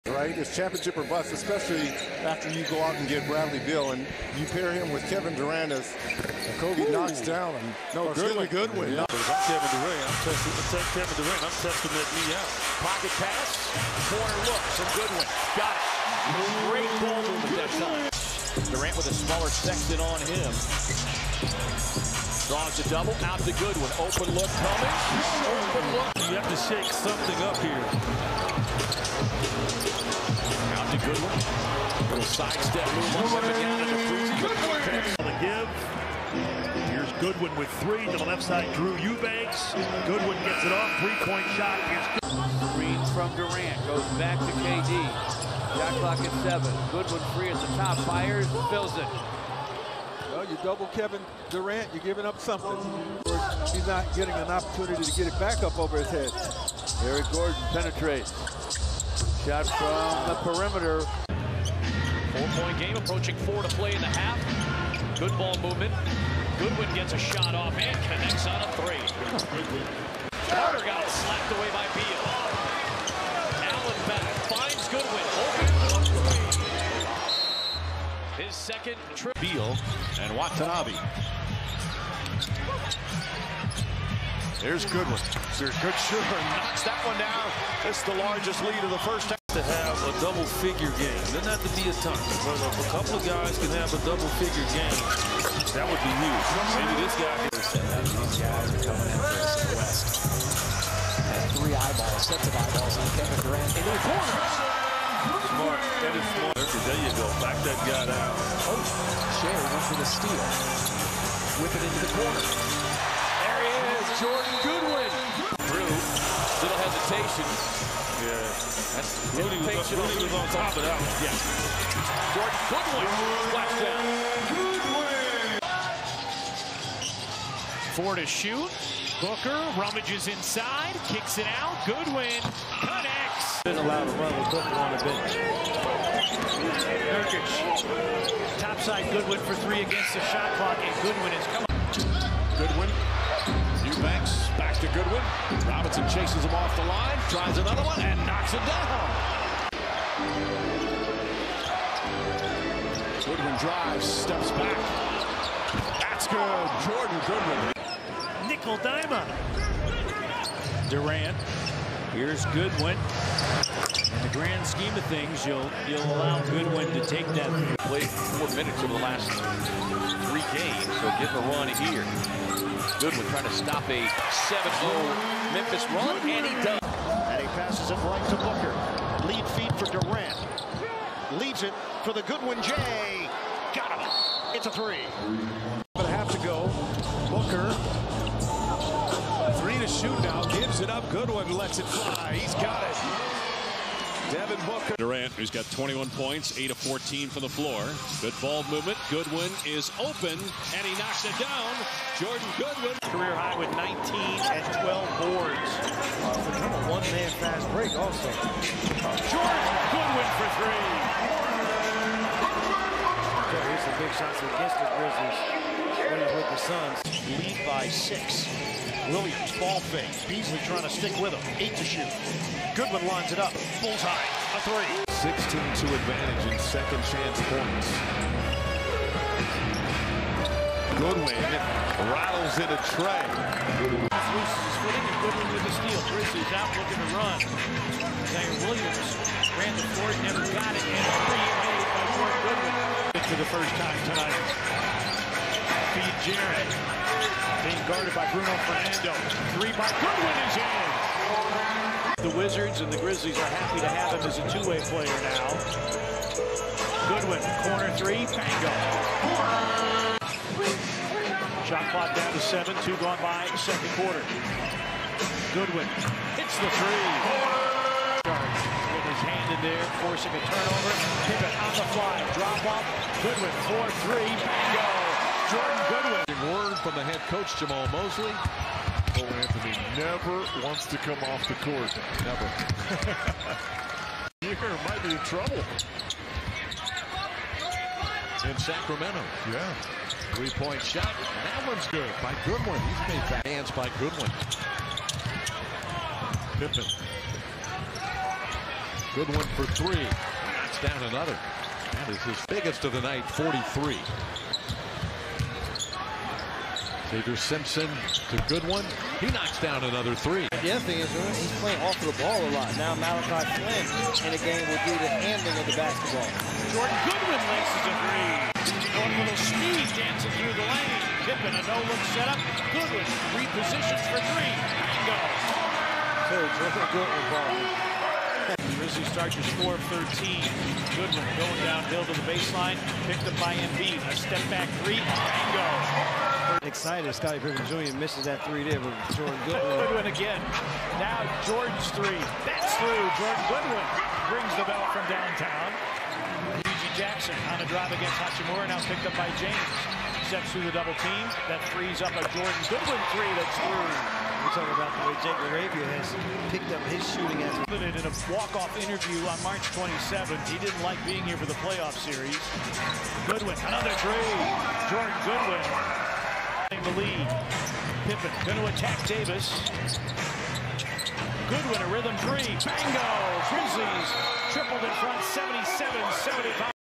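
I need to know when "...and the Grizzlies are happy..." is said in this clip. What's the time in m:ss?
4:12.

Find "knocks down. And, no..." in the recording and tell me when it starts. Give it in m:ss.
0:06.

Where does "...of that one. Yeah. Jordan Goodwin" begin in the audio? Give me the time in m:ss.
2:00.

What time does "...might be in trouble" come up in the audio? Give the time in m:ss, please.
4:44.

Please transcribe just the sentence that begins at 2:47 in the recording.
Played four minutes over the last three games, so get a run here.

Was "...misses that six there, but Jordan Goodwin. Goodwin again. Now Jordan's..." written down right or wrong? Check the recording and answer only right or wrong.
wrong.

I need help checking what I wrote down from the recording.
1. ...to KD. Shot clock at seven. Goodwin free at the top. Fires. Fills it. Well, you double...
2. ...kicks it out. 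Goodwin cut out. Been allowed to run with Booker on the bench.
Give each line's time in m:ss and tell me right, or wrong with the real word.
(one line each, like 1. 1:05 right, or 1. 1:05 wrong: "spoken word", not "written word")
1. 0:44 right
2. 2:11 right.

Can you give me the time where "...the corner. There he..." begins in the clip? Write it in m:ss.
1:52.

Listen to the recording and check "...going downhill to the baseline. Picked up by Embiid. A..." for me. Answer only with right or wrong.
right.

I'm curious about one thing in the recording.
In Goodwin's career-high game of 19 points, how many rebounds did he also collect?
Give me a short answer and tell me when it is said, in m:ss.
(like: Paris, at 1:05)
12, at 3:24.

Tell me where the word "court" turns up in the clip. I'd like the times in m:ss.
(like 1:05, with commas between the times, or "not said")
3:59, 4:41.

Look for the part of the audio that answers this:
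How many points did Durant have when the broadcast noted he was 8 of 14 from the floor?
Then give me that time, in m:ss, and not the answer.
3:15.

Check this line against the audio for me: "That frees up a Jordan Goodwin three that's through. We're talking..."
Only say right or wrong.
right.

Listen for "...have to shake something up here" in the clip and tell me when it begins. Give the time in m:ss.
0:26.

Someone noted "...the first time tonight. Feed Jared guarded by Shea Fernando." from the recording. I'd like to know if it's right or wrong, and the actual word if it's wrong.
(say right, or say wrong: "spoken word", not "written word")
wrong: "Bruno", not "Shea".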